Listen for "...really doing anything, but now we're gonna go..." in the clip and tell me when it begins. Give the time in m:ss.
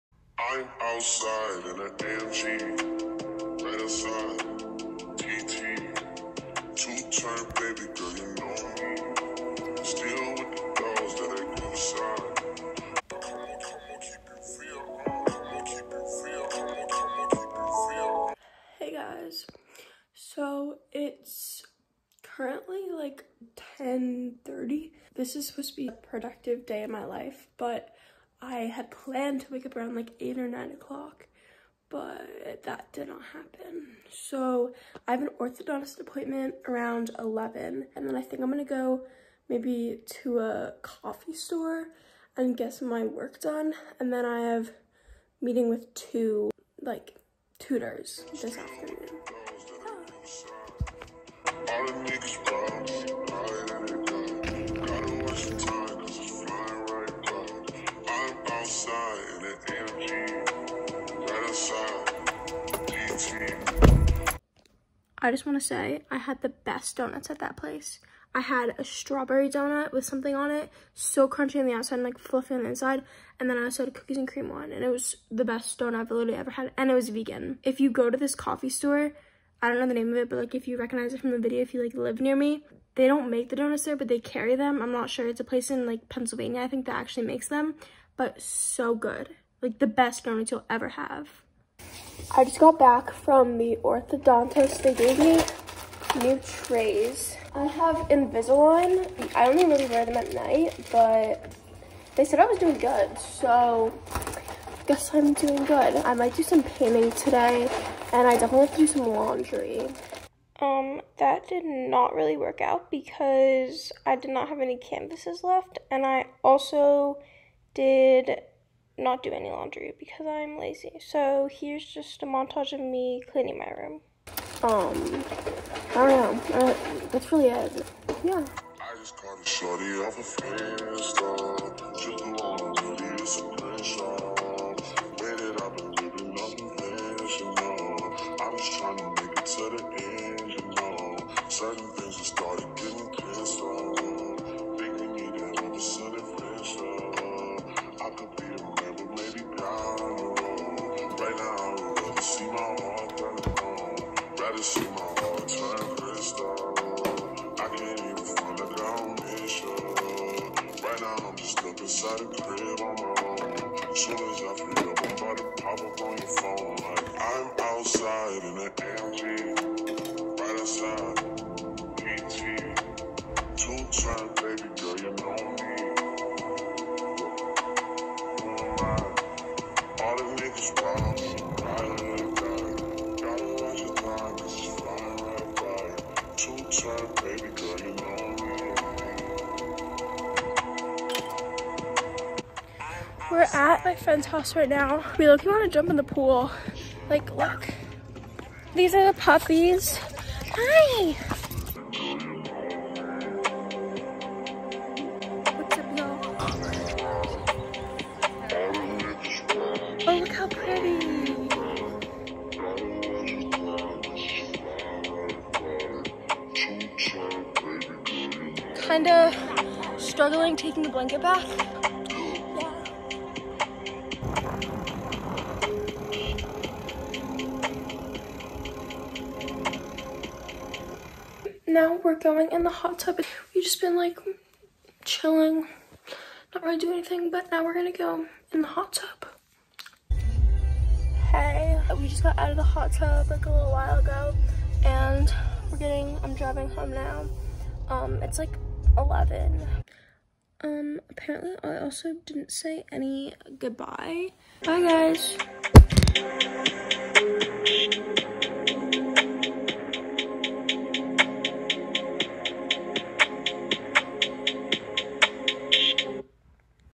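3:56.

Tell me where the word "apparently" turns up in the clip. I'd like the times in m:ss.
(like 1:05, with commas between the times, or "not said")
4:11.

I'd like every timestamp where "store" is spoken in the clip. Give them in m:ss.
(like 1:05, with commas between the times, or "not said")
0:41, 1:18.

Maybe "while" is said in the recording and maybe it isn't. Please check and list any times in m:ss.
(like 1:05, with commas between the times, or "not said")
4:03.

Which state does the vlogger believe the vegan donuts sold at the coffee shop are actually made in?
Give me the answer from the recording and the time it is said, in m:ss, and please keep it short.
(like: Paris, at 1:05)
Pennsylvania, at 1:26.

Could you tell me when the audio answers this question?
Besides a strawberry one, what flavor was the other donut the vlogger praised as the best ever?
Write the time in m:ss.
1:13.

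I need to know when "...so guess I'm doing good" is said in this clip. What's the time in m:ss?
1:43.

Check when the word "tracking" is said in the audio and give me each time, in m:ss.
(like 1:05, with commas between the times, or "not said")
not said.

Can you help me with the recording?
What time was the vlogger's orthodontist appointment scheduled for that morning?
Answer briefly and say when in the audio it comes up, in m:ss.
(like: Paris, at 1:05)
11, at 0:36.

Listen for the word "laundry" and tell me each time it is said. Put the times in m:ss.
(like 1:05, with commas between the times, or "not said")
1:49, 1:59.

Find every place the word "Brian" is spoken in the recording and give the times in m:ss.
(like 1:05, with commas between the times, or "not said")
not said.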